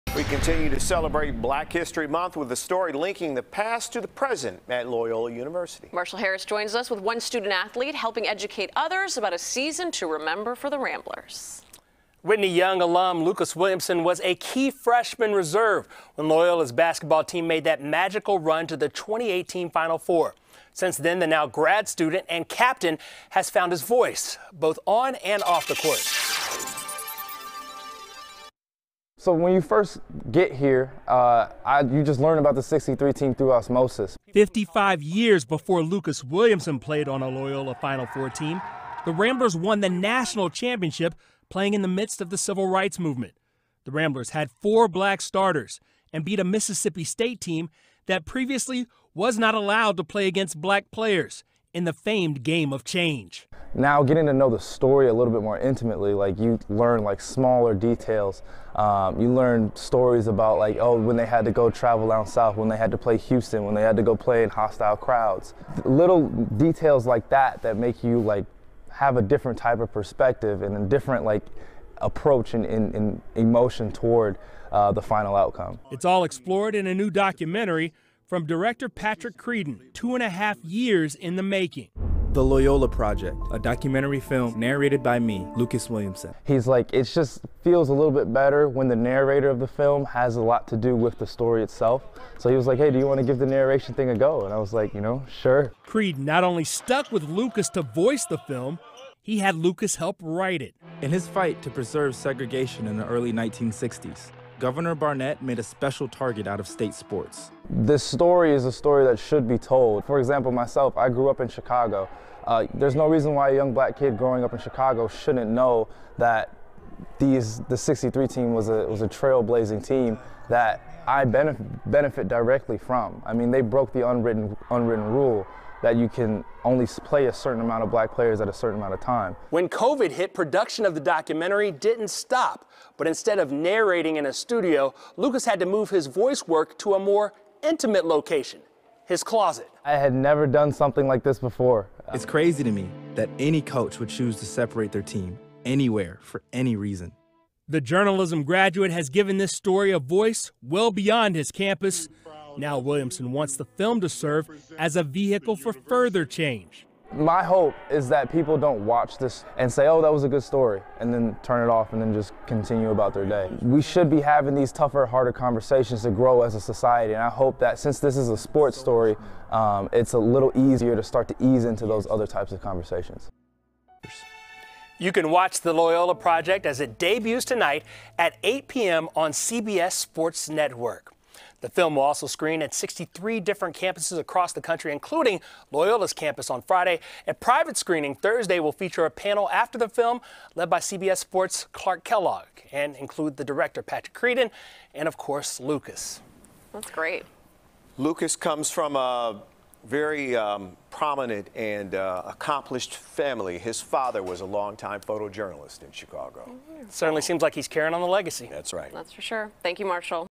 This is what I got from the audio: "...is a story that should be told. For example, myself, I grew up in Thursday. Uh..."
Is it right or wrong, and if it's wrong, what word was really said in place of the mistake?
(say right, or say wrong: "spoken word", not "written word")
wrong: "Chicago", not "Thursday".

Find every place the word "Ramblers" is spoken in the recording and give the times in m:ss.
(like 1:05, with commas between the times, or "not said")
0:10, 0:39, 0:43.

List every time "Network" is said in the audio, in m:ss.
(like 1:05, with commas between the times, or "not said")
3:00.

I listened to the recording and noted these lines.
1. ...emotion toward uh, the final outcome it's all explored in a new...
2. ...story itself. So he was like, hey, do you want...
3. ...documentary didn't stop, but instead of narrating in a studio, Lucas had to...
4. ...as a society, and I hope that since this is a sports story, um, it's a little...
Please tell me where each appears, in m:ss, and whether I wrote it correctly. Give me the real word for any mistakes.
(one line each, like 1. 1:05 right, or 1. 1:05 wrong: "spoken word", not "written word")
1. 1:13 right
2. 1:31 right
3. 2:10 right
4. 2:46 right.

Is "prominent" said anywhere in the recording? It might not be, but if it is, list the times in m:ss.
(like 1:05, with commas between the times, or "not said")
3:20.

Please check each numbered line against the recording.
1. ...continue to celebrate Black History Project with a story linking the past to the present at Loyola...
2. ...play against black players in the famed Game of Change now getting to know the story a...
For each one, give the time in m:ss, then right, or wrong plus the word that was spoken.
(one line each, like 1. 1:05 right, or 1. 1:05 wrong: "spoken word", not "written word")
1. 0:00 wrong: "Month", not "Project"
2. 0:50 right.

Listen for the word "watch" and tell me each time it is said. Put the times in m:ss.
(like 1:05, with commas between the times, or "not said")
2:38, 2:55.